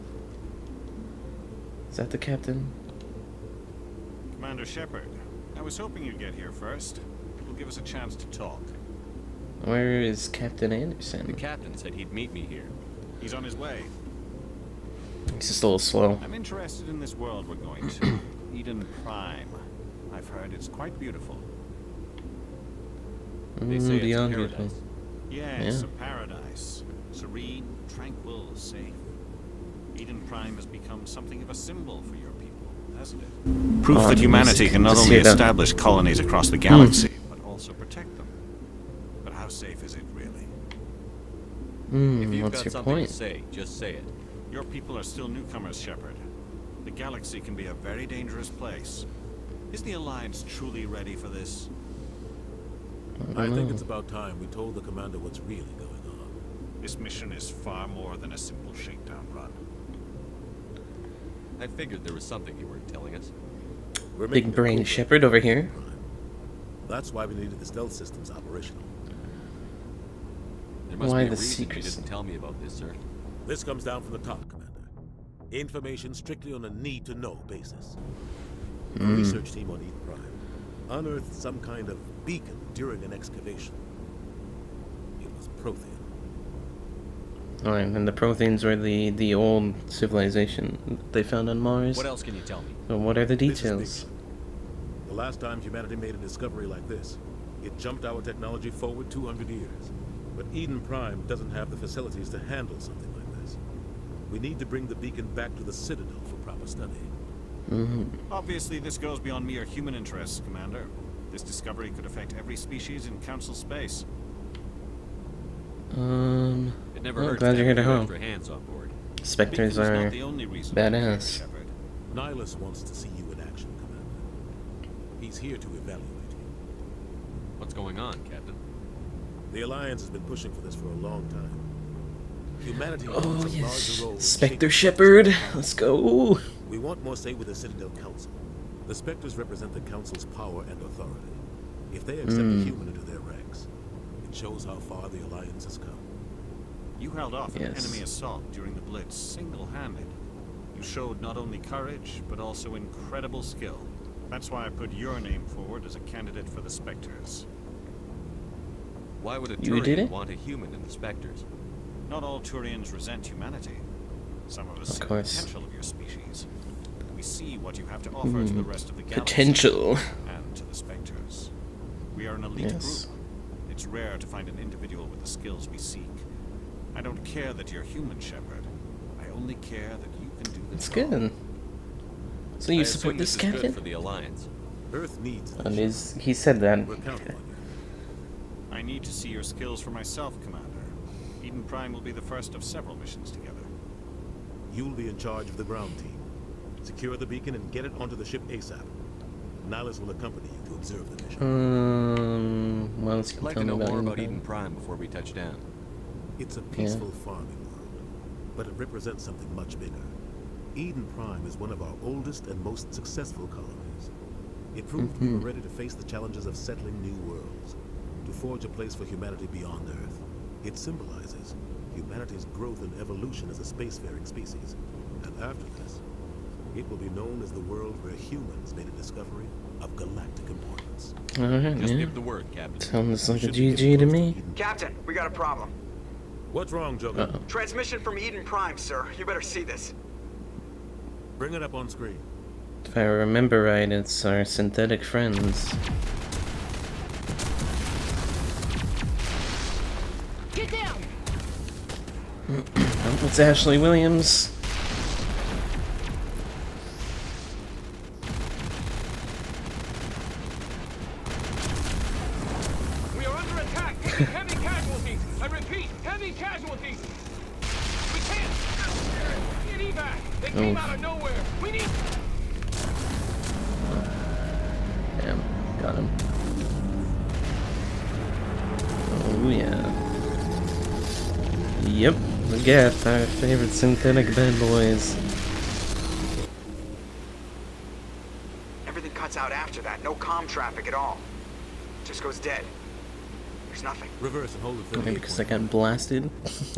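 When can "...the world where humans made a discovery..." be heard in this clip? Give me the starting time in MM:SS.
03:47.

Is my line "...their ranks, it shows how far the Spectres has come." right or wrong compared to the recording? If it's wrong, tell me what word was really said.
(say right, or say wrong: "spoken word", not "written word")
wrong: "Alliance", not "Spectres".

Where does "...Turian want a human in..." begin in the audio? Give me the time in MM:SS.
02:39.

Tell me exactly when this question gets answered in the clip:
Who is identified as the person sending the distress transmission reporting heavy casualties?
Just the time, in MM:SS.
04:13.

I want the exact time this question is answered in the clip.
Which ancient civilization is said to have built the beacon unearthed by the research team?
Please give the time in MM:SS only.
01:25.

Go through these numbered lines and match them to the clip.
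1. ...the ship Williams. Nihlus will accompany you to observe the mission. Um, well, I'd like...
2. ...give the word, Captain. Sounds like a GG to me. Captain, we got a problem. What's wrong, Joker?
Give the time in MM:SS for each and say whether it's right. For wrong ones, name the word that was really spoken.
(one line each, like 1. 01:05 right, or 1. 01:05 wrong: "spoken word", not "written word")
1. 03:18 wrong: "ASAP", not "Williams"
2. 03:51 right.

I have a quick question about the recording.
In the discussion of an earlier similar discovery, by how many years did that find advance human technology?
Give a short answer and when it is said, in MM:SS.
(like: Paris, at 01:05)
200, at 01:39.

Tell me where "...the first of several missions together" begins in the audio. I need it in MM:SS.
03:12.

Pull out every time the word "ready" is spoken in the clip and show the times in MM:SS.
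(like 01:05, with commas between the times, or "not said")
00:50, 03:35.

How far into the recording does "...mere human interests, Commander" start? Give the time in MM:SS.
01:49.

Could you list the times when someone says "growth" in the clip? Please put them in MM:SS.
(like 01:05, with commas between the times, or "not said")
03:42.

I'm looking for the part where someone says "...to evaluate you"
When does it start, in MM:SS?
02:05.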